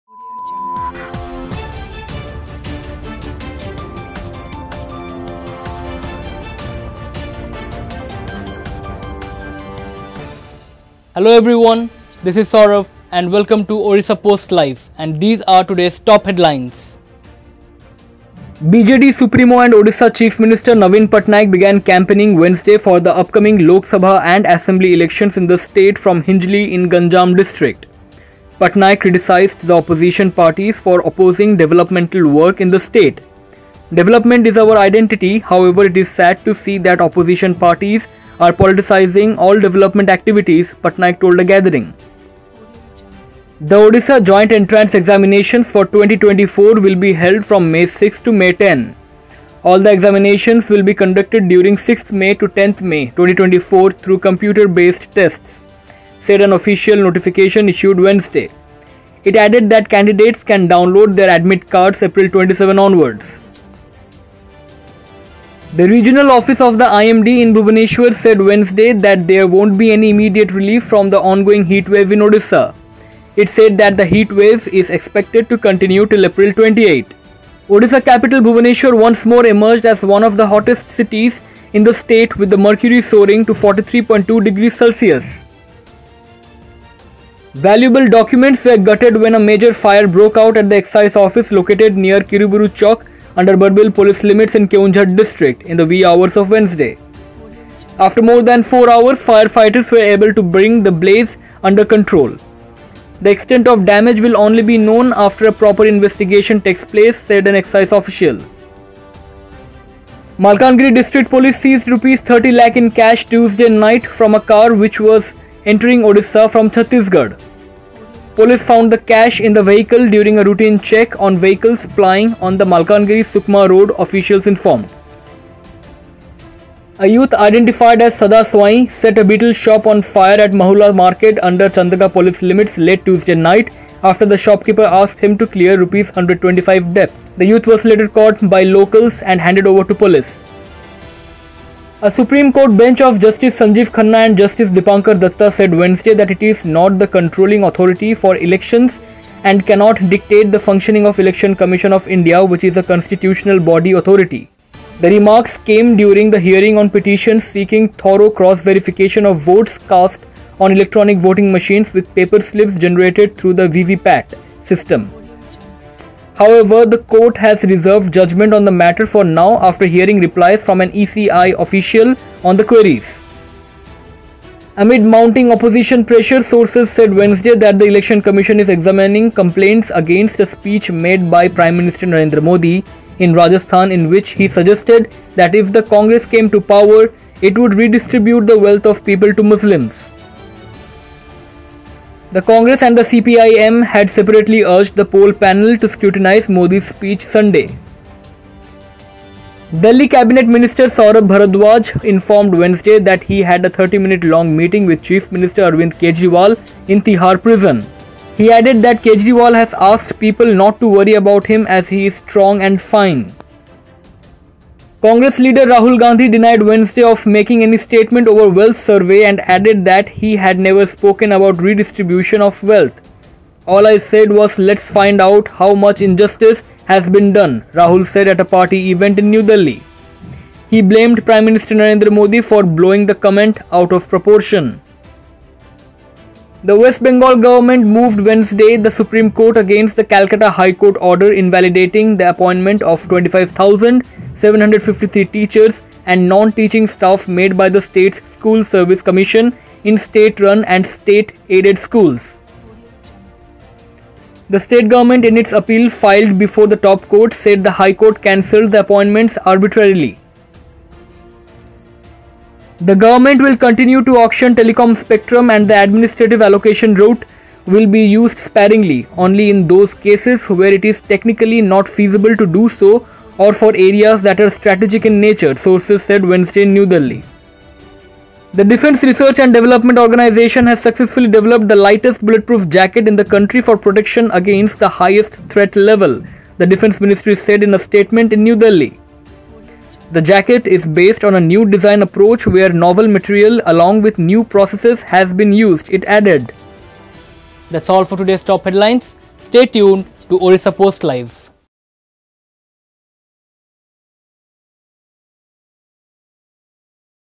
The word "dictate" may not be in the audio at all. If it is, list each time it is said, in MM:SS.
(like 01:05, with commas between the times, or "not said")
02:30.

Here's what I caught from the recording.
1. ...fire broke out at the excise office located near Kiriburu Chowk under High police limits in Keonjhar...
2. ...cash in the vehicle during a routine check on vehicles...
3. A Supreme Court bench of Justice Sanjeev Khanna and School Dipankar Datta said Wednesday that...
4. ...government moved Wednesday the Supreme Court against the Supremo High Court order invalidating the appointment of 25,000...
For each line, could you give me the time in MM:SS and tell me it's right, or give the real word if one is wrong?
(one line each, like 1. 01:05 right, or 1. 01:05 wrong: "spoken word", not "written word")
1. 01:29 wrong: "Barbil", not "High"
2. 01:58 right
3. 02:22 wrong: "Justice", not "School"
4. 03:57 wrong: "Calcutta", not "Supremo".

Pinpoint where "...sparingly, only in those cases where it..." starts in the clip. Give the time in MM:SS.
04:28.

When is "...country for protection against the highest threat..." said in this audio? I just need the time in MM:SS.
04:43.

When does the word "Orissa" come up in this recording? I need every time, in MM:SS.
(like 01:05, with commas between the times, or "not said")
00:13, 05:00.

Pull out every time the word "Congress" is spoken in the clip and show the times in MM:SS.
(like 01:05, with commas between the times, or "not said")
03:05, 03:12, 03:35.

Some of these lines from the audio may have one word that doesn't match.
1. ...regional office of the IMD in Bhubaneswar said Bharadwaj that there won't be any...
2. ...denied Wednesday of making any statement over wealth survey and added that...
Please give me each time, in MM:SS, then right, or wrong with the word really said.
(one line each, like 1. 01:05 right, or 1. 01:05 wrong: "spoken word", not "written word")
1. 01:05 wrong: "Wednesday", not "Bharadwaj"
2. 03:36 right.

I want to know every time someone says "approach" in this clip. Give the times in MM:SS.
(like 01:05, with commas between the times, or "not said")
04:52.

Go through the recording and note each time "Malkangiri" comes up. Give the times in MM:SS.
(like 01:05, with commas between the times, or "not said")
01:50, 02:02.